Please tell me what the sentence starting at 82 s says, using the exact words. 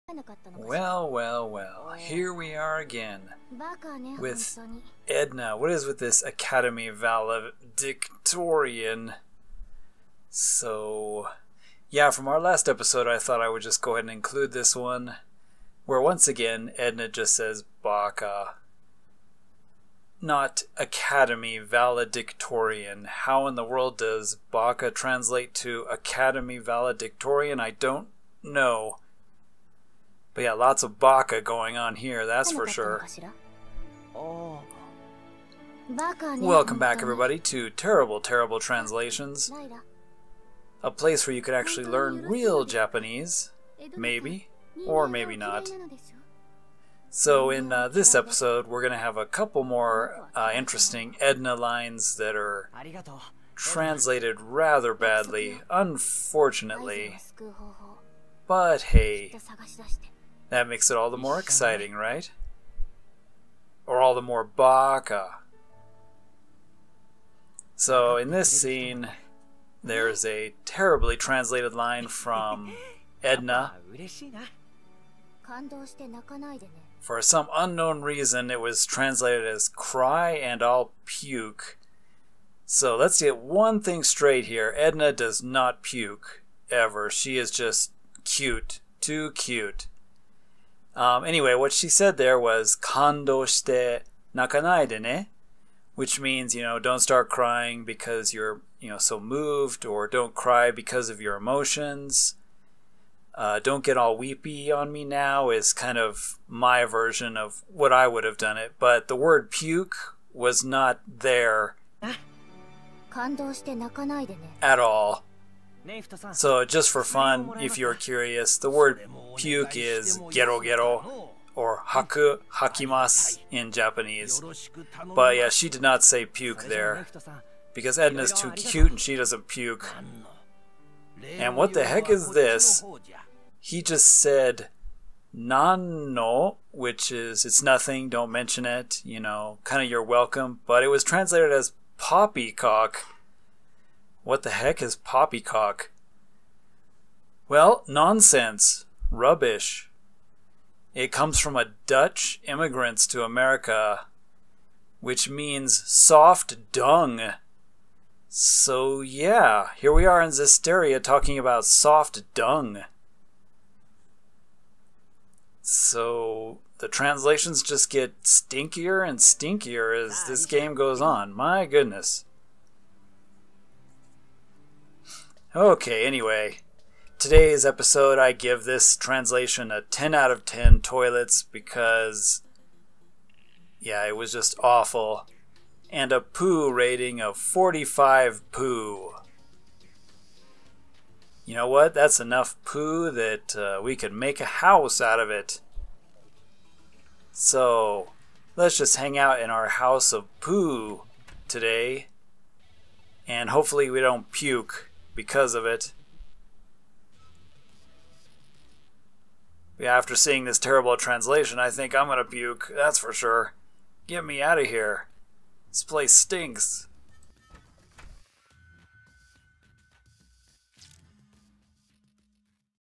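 So let's get one thing straight here.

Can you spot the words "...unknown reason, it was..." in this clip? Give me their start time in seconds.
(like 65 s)
77 s.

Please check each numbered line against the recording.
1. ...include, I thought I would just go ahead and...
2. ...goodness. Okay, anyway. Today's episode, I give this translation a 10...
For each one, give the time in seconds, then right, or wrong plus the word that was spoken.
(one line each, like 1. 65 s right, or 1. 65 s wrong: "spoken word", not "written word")
1. 12 s wrong: "episode", not "include"
2. 171 s right.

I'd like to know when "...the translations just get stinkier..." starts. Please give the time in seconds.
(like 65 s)
166 s.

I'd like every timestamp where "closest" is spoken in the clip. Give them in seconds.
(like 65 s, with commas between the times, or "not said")
not said.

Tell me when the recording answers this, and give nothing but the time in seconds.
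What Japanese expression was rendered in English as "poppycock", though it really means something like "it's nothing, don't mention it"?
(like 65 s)
135 s.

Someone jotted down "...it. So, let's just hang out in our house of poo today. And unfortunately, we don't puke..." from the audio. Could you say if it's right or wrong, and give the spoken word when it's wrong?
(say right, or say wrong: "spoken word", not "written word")
wrong: "hopefully", not "unfortunately".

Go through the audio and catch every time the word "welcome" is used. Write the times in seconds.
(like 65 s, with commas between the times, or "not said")
36 s, 140 s.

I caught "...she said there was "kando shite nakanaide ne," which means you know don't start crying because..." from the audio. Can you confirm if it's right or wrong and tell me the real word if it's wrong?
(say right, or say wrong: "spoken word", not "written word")
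right.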